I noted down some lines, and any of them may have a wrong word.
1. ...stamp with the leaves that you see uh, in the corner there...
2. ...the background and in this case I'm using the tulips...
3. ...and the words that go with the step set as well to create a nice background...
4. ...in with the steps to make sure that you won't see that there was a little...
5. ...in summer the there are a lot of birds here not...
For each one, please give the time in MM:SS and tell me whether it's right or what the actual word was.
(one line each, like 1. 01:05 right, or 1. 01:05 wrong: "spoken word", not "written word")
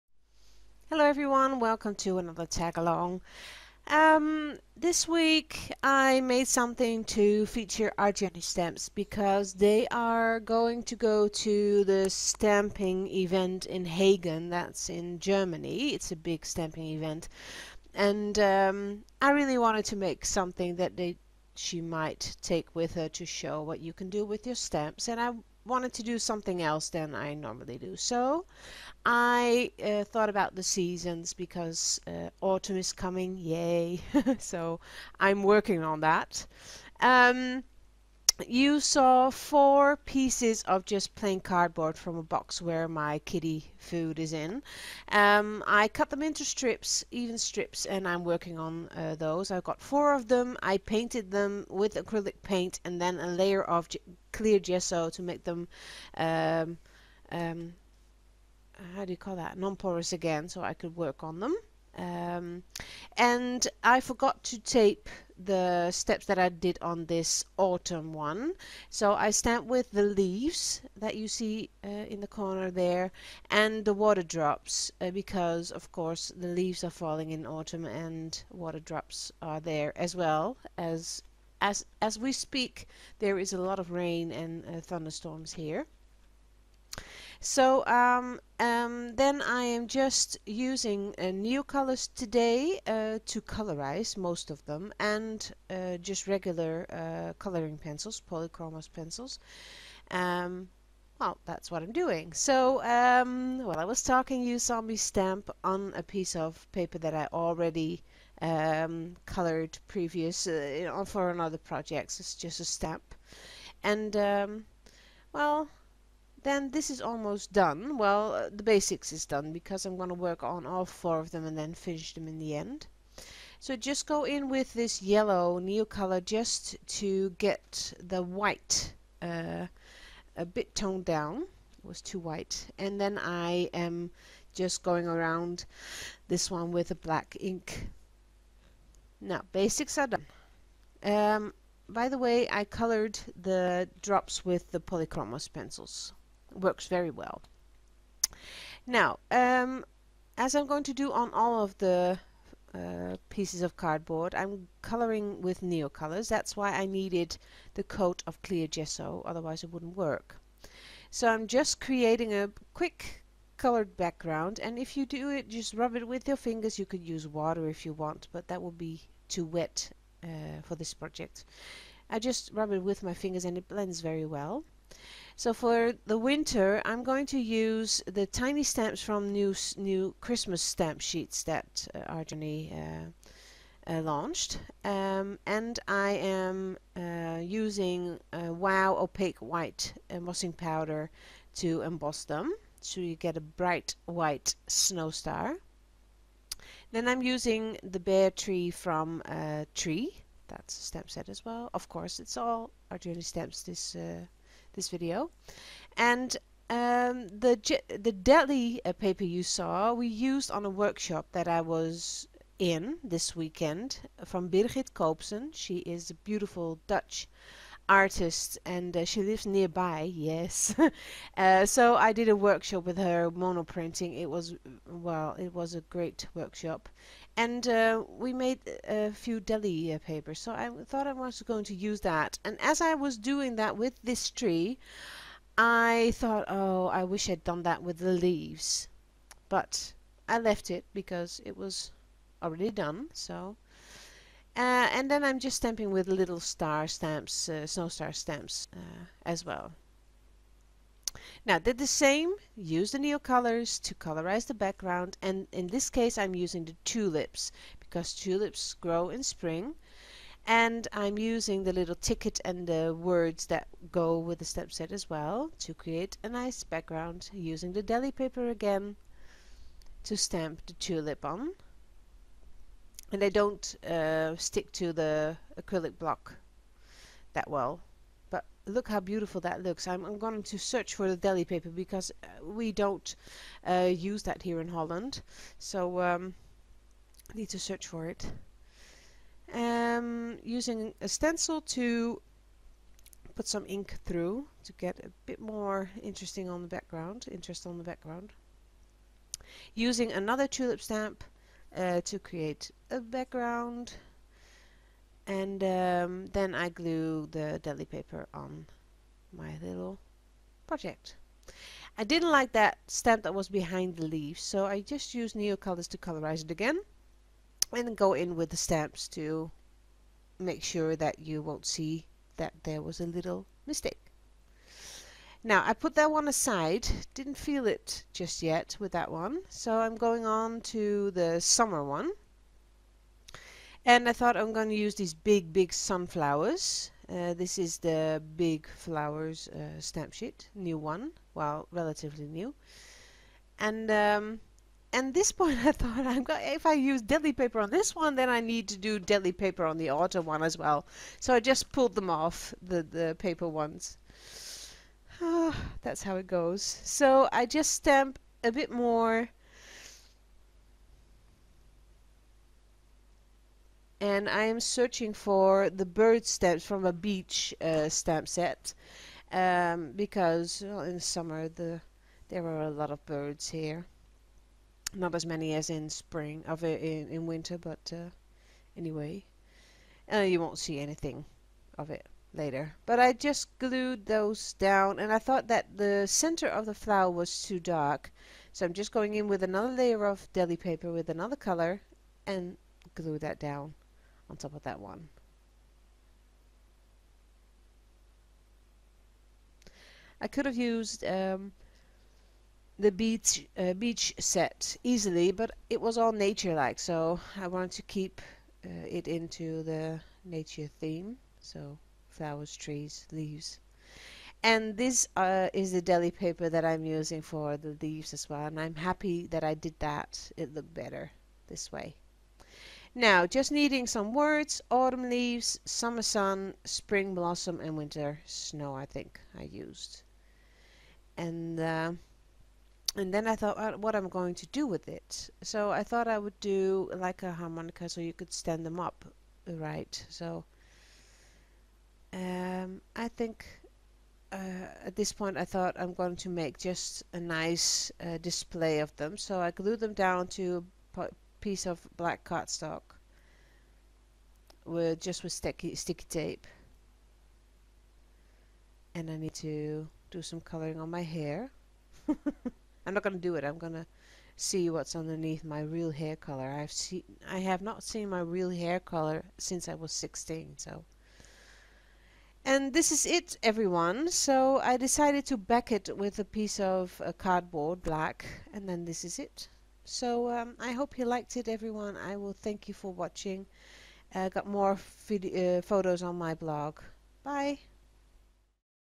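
1. 01:09 right
2. 04:14 right
3. 04:22 right
4. 05:18 wrong: "stamps", not "steps"
5. 06:10 right.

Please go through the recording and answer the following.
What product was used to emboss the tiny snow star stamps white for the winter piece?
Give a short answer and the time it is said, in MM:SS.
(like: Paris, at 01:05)
Wow opaque white embossing powder, at 03:08.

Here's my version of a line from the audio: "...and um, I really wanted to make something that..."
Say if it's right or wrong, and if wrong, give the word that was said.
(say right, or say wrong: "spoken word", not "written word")
right.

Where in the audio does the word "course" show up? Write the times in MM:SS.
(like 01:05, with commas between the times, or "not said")
01:15, 03:21.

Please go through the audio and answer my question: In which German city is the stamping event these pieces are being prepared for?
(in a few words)
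Hagen.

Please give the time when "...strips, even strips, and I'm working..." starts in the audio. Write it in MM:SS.
00:46.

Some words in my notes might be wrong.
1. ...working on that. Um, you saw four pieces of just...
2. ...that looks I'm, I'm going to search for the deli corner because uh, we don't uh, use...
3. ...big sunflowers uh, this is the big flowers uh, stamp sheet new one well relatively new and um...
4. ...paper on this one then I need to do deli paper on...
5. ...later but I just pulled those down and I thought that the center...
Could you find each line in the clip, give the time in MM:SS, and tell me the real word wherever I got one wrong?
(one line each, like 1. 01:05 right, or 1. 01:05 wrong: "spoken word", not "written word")
1. 00:35 right
2. 04:39 wrong: "paper", not "corner"
3. 05:35 right
4. 05:47 right
5. 06:22 wrong: "glued", not "pulled".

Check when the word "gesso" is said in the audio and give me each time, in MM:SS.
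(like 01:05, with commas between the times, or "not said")
00:54, 02:38.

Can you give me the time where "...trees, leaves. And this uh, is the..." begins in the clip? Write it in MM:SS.
06:52.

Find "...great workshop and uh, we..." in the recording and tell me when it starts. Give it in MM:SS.
03:45.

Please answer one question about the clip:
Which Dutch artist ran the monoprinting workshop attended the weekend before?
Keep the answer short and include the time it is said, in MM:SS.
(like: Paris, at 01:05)
Birgit Koopsen, at 03:34.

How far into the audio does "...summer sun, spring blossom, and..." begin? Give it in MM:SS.
07:05.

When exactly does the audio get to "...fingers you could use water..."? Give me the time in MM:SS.
02:46.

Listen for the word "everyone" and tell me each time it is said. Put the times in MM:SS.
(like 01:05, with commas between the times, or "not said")
00:01, 07:53, 08:01.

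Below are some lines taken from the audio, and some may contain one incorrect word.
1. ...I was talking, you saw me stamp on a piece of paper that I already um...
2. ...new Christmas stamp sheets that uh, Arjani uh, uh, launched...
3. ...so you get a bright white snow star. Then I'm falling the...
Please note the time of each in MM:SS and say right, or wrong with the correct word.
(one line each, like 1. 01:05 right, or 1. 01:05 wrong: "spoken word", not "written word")
1. 01:43 right
2. 02:59 right
3. 03:12 wrong: "using", not "falling".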